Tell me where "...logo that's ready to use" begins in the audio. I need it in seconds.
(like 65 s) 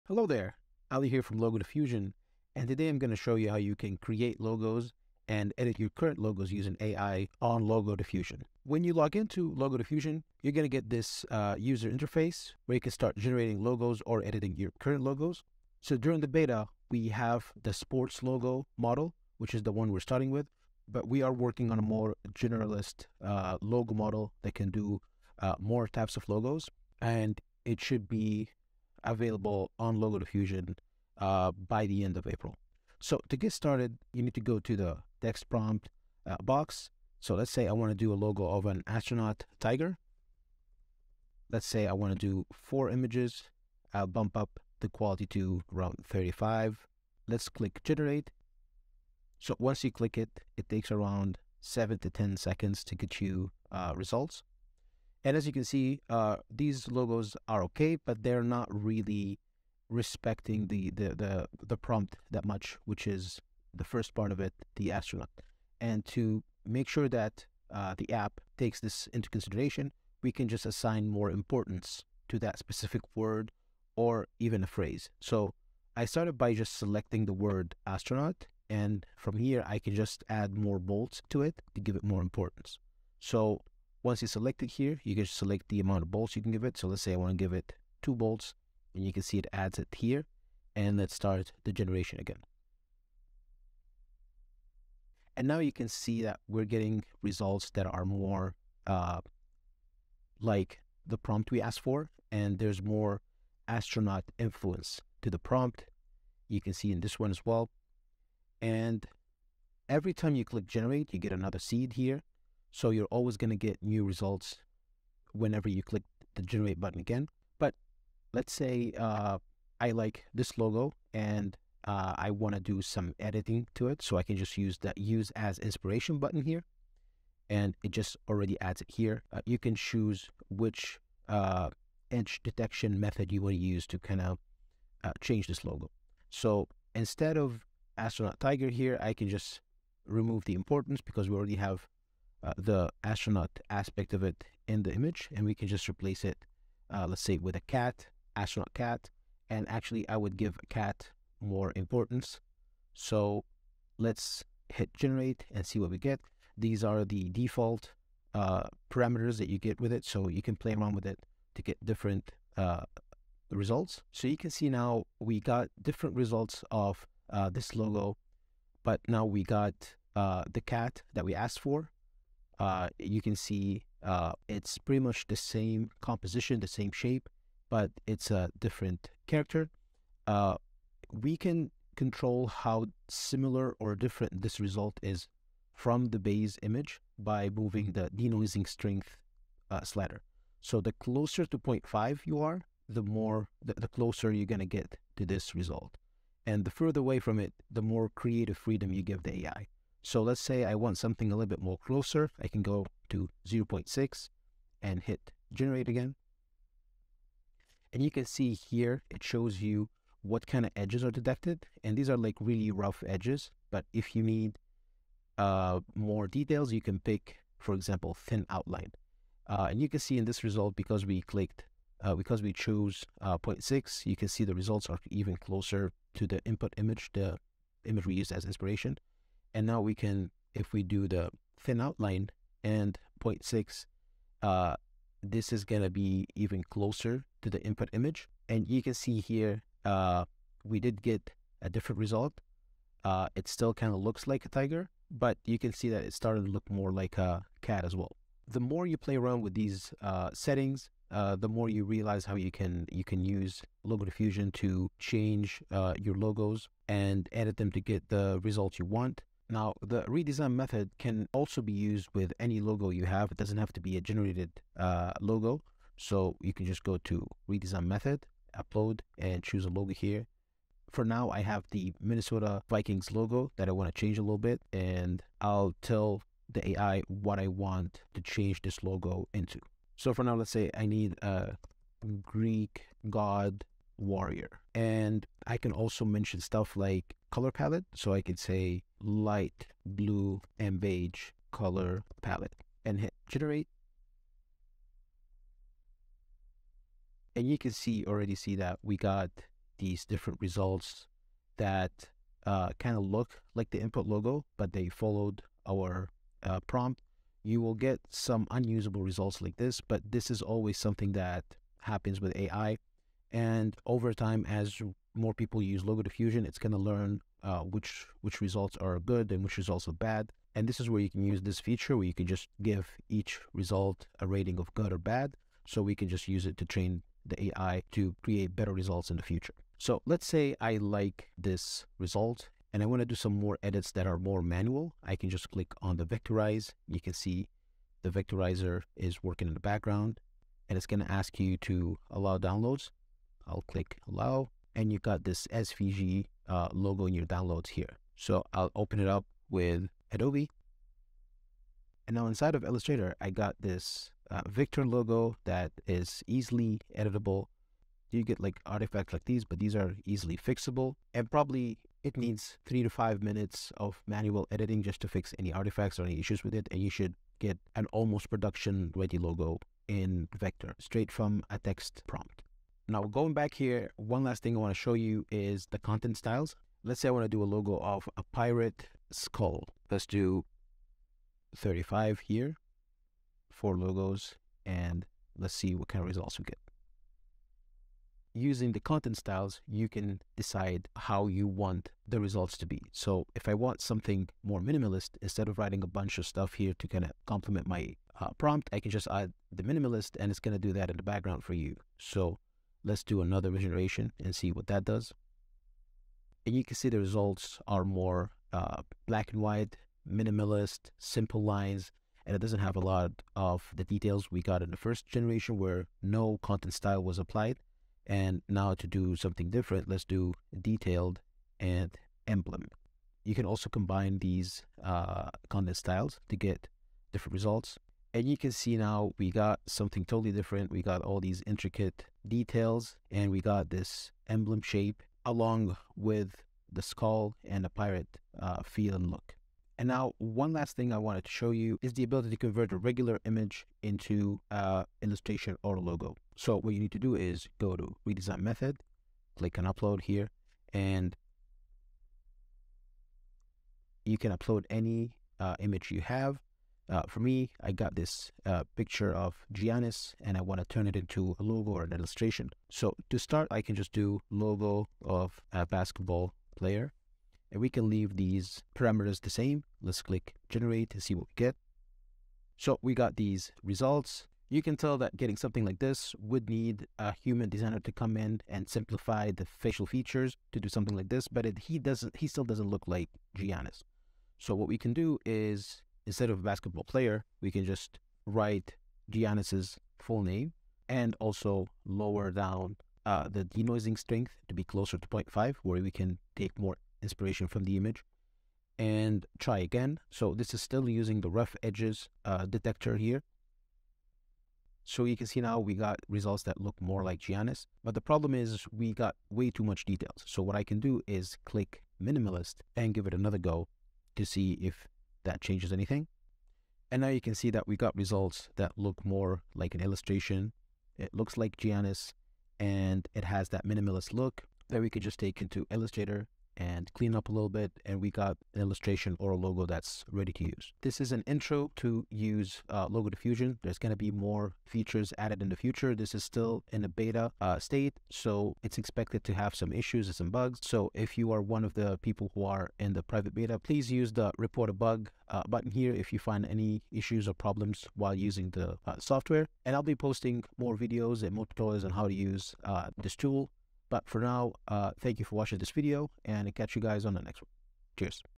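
529 s.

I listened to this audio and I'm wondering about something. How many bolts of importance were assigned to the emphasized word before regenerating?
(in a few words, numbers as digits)
2.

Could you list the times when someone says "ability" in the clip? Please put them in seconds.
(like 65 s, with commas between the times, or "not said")
442 s.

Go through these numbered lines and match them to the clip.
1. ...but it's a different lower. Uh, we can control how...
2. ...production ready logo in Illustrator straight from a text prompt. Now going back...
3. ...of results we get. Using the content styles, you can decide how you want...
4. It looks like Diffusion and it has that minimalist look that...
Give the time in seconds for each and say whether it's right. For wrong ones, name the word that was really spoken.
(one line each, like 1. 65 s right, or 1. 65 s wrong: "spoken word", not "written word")
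1. 177 s wrong: "character", not "lower"
2. 368 s wrong: "Vector", not "Illustrator"
3. 386 s right
4. 520 s wrong: "Giannis", not "Diffusion".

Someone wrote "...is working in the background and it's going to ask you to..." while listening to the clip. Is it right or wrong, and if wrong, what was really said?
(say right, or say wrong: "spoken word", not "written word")
right.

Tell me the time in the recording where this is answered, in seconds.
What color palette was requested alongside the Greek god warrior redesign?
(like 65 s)
289 s.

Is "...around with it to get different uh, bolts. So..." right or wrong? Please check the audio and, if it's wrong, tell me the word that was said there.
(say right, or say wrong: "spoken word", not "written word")
wrong: "results", not "bolts".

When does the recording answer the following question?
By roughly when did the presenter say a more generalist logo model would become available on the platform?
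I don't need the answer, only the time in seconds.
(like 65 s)
31 s.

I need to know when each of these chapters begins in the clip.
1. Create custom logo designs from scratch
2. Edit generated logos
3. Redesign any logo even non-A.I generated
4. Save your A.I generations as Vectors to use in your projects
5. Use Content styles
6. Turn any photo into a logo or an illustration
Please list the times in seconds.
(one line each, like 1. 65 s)
1. 33 s
2. 118 s
3. 260 s
4. 330 s
5. 372 s
6. 439 s.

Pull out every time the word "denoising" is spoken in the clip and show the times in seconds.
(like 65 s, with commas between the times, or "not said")
188 s, 493 s.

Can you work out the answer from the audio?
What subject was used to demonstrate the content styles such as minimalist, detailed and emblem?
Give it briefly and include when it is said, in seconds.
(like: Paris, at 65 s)
Pirate skull, at 378 s.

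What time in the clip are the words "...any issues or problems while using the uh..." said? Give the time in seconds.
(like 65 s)
546 s.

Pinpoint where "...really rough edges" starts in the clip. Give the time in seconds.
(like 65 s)
212 s.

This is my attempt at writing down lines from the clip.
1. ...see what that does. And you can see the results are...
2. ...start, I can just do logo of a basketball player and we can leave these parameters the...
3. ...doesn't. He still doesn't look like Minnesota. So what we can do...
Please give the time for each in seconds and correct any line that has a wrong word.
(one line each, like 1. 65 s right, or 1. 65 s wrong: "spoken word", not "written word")
1. 404 s right
2. 463 s right
3. 481 s wrong: "Giannis", not "Minnesota".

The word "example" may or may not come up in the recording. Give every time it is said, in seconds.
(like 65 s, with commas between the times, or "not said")
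217 s.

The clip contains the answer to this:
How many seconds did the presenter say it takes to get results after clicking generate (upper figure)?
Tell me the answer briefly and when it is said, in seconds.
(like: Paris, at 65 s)
10, at 51 s.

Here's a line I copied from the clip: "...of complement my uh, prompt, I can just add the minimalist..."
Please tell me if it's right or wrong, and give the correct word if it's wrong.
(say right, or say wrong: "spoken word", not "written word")
right.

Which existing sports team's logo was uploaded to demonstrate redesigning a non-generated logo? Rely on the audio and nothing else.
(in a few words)
Minnesota Vikings.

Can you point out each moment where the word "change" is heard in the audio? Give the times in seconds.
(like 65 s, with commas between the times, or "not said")
135 s, 254 s, 273 s, 278 s, 515 s.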